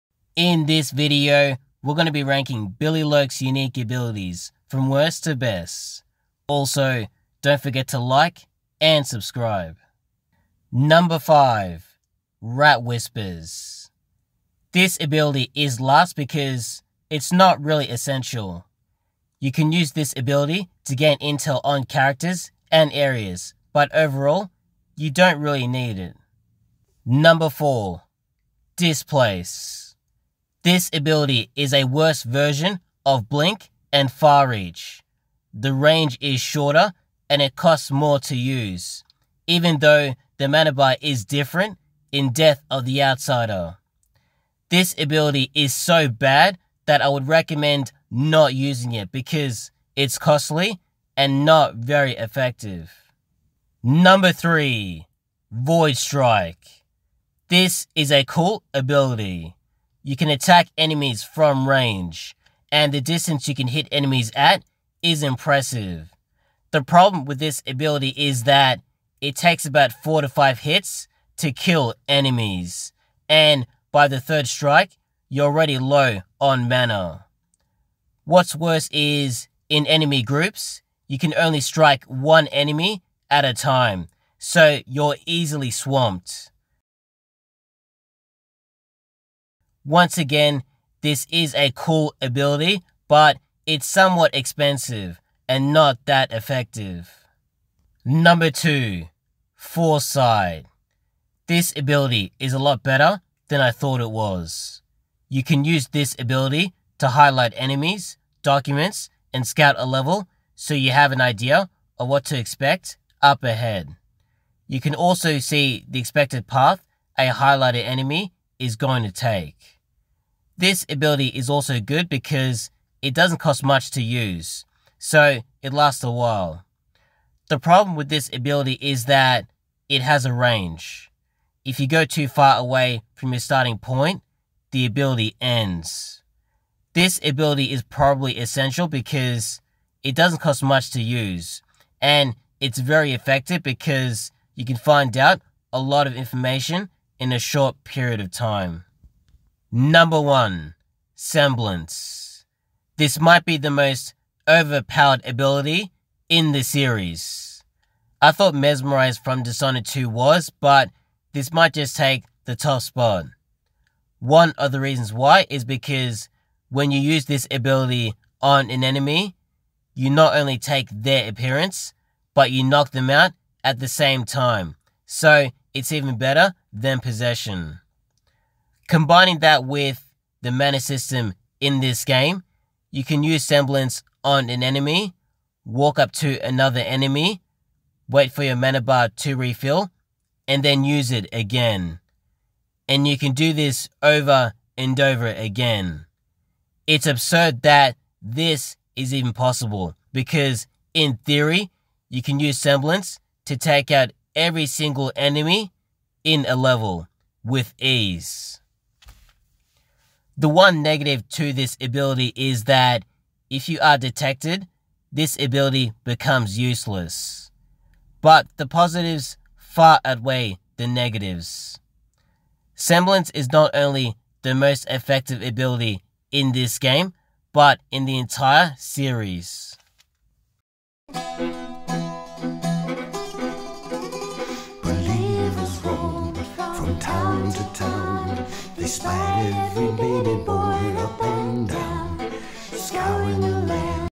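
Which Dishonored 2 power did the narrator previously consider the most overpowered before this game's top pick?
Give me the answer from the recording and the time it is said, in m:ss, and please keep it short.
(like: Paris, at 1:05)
Mesmerize, at 2:38.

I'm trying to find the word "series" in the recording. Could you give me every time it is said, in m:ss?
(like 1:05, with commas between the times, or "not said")
2:36, 3:48.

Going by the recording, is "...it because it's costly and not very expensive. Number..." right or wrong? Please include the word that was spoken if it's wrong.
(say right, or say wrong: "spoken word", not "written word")
wrong: "effective", not "expensive".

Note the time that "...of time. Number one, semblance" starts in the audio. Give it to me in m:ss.
2:28.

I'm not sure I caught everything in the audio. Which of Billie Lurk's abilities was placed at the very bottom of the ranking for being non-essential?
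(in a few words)
Rat Whispers.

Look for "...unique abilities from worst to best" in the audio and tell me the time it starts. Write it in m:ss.
0:03.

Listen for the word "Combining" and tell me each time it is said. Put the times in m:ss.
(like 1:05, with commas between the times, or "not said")
2:58.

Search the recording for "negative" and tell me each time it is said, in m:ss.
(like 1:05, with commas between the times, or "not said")
3:30, 3:40.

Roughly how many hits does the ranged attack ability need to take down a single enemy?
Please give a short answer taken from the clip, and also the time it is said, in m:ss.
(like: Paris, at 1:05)
4 to 5, at 1:09.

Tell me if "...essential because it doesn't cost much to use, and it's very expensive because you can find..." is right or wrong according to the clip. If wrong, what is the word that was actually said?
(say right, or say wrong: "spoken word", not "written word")
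wrong: "effective", not "expensive".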